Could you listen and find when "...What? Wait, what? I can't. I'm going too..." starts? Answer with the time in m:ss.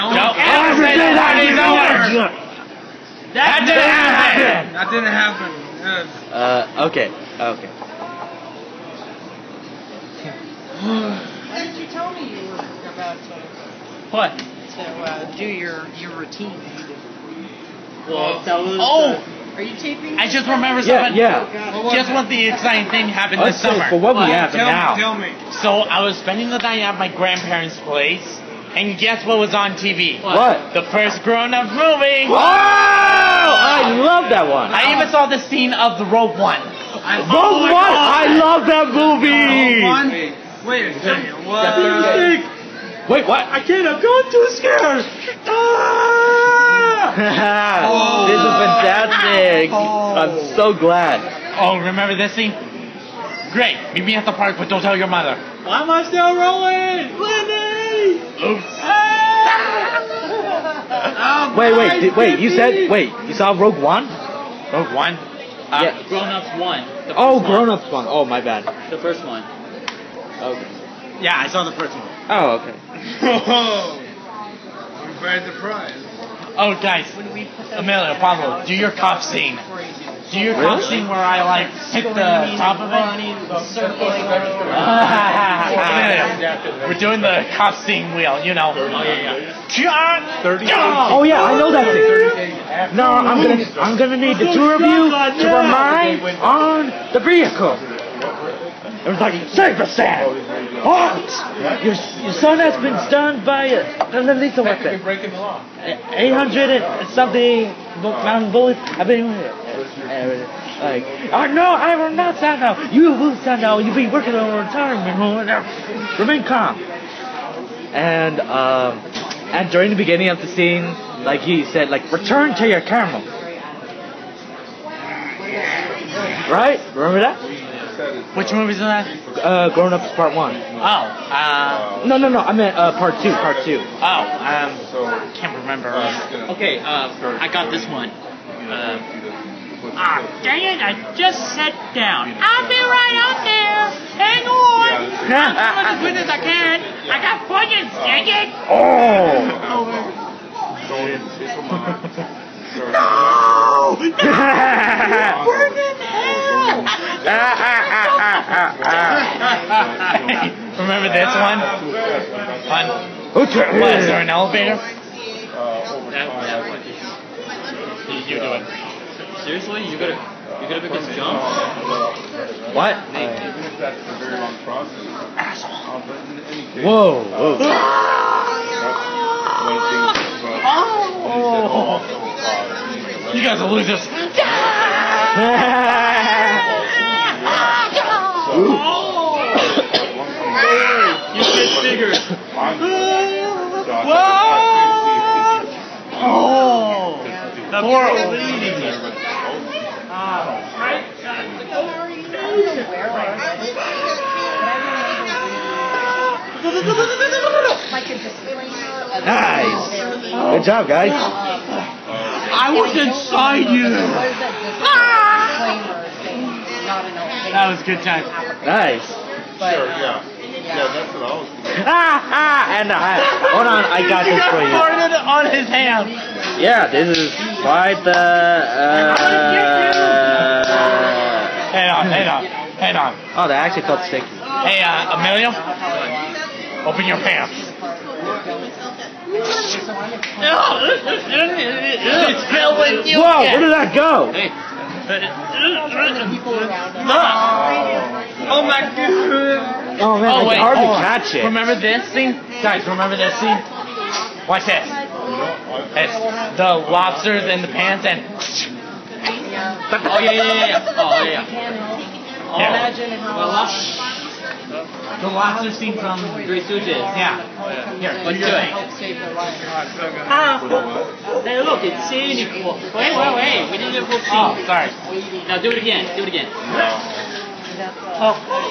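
0:41.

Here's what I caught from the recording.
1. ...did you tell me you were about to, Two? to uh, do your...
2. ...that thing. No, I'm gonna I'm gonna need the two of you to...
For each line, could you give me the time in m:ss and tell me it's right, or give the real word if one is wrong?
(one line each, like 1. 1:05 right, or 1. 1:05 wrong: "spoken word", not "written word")
1. 0:11 wrong: "What", not "Two"
2. 1:31 right.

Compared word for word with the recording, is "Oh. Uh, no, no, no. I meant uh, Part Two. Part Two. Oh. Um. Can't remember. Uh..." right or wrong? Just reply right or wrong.
right.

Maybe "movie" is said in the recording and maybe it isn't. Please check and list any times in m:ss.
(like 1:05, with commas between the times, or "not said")
0:31, 0:38, 2:08.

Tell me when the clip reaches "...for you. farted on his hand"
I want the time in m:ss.
3:44.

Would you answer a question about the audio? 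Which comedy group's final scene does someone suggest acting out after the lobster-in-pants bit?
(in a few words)
Three Stooges.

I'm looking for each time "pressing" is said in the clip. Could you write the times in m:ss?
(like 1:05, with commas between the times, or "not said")
not said.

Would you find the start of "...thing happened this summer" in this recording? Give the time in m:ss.
0:22.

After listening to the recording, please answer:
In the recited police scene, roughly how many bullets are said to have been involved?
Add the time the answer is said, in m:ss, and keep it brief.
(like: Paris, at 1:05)
800 something, at 1:45.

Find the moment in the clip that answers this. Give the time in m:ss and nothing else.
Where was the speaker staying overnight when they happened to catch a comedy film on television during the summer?
0:27.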